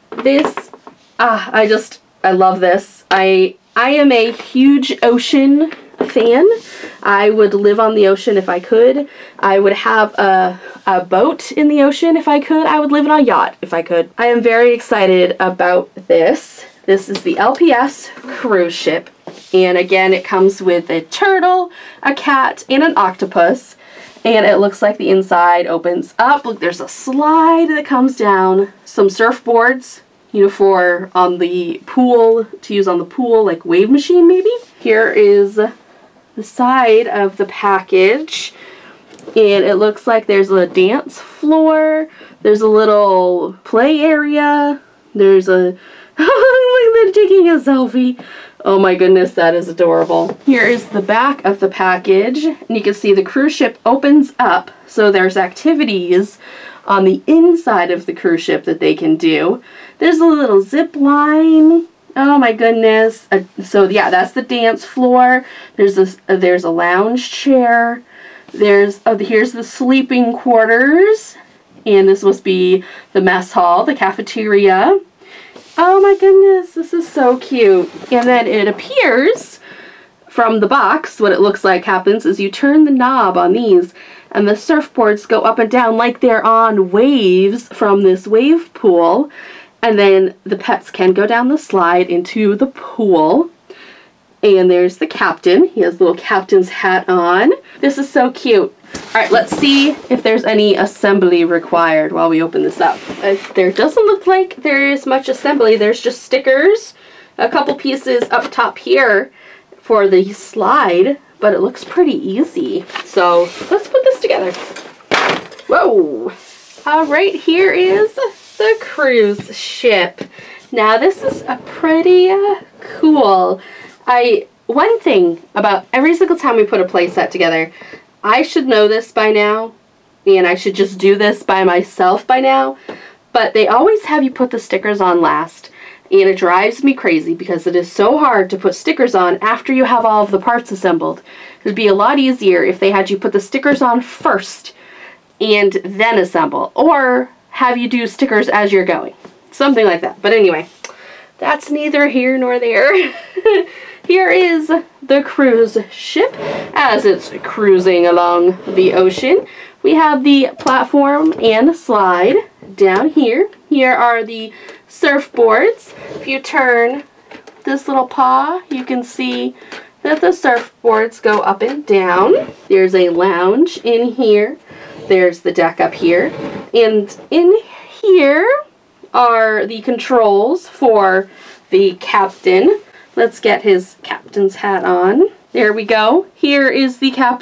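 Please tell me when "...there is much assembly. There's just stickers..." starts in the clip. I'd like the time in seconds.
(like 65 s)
104 s.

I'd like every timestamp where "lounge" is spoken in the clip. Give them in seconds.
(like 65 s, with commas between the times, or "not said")
66 s, 173 s.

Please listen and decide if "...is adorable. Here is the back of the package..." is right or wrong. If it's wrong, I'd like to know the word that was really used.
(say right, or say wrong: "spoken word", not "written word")
right.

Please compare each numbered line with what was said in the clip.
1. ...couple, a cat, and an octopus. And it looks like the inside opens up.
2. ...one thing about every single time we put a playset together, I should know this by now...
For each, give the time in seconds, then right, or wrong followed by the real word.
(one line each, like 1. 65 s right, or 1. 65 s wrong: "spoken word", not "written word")
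1. 21 s wrong: "turtle", not "couple"
2. 124 s right.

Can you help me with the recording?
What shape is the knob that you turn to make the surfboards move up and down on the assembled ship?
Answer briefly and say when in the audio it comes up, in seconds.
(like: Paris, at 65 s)
Paw, at 168 s.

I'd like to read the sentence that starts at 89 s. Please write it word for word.
And then the pets can go down the slide into the pool.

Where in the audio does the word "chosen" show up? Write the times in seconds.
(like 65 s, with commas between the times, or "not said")
not said.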